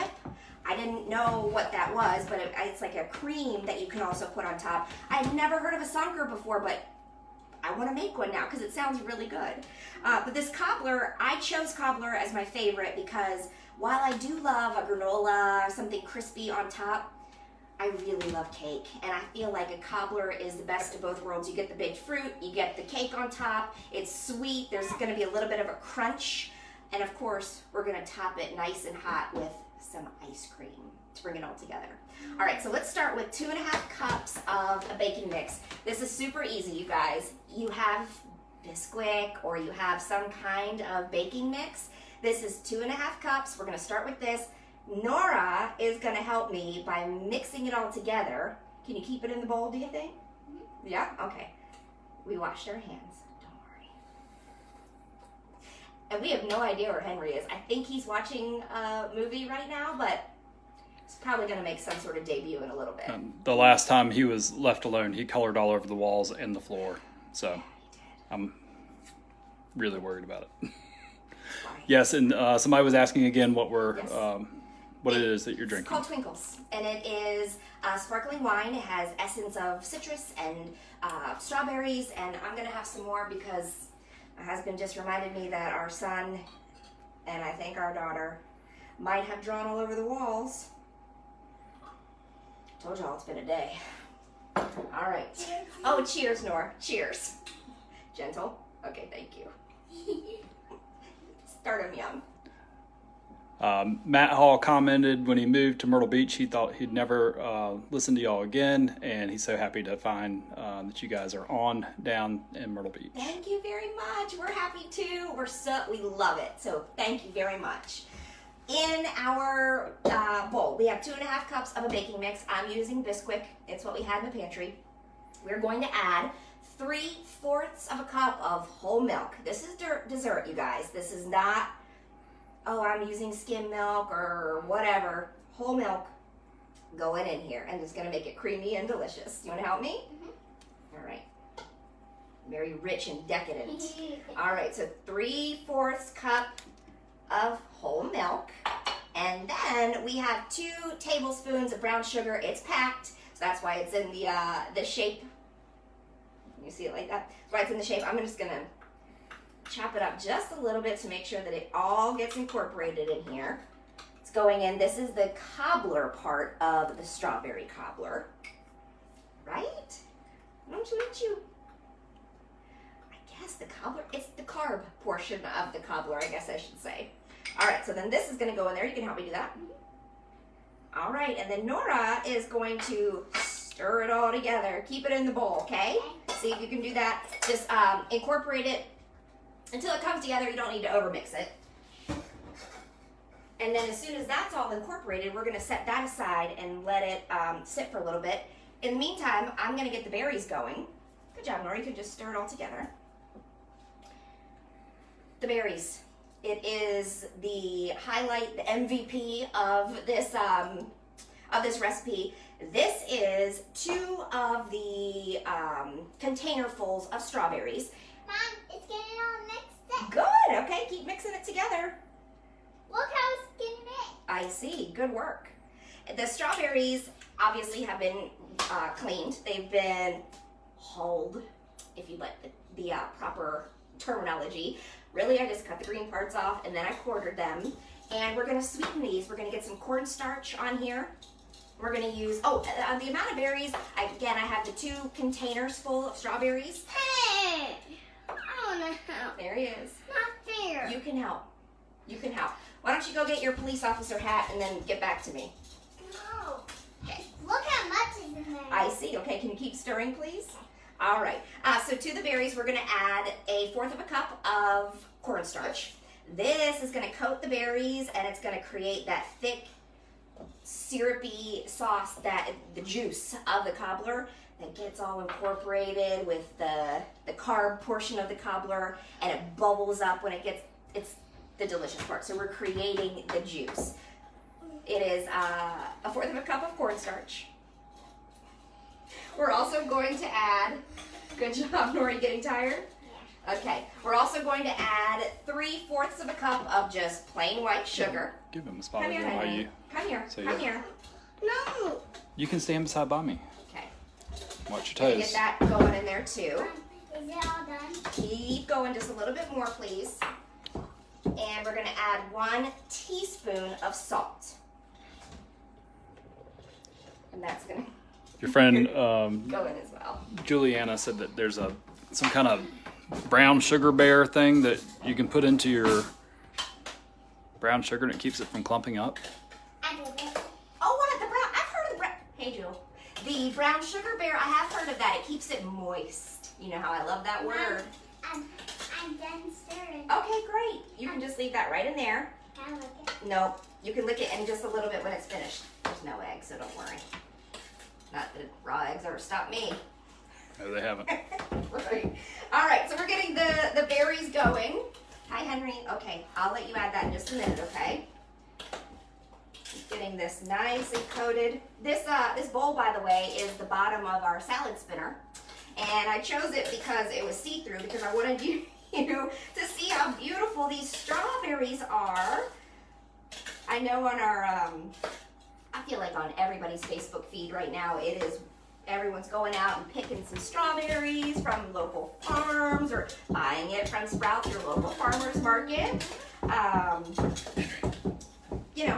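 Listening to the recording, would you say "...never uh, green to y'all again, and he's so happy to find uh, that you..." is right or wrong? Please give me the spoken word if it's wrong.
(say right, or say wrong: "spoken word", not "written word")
wrong: "listen", not "green".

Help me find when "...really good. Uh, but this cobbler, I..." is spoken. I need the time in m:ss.
0:09.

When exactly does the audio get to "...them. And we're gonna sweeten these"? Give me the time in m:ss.
3:57.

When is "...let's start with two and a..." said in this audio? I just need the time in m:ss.
0:32.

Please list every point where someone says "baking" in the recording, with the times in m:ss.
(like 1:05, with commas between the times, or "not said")
0:34, 0:41, 2:01.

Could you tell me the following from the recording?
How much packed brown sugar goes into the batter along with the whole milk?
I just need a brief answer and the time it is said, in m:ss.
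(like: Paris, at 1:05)
2 tablespoons, at 2:30.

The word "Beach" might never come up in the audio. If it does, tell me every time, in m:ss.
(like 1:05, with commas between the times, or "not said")
1:46, 1:52.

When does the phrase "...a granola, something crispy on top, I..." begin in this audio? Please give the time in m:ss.
0:14.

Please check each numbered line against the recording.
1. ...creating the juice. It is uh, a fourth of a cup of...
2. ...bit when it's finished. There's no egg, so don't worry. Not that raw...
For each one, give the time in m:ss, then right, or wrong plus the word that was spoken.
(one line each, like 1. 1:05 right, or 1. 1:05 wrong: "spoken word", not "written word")
1. 4:42 right
2. 5:44 right.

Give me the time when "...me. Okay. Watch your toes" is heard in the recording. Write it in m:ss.
5:03.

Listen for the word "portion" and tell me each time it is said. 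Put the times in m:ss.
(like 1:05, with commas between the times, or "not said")
2:55, 4:37.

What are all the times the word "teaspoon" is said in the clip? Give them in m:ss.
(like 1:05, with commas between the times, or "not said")
5:12.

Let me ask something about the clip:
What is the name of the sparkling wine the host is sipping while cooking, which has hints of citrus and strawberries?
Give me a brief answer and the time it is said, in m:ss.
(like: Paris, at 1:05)
Twinkles, at 1:16.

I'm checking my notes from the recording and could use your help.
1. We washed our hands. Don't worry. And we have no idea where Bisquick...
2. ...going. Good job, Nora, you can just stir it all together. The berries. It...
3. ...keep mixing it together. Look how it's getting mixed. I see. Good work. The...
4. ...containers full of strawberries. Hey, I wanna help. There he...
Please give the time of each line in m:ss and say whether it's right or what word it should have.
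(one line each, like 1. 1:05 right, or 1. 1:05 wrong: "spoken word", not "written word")
1. 0:52 wrong: "Henry", not "Bisquick"
2. 3:20 right
3. 3:40 right
4. 4:05 right.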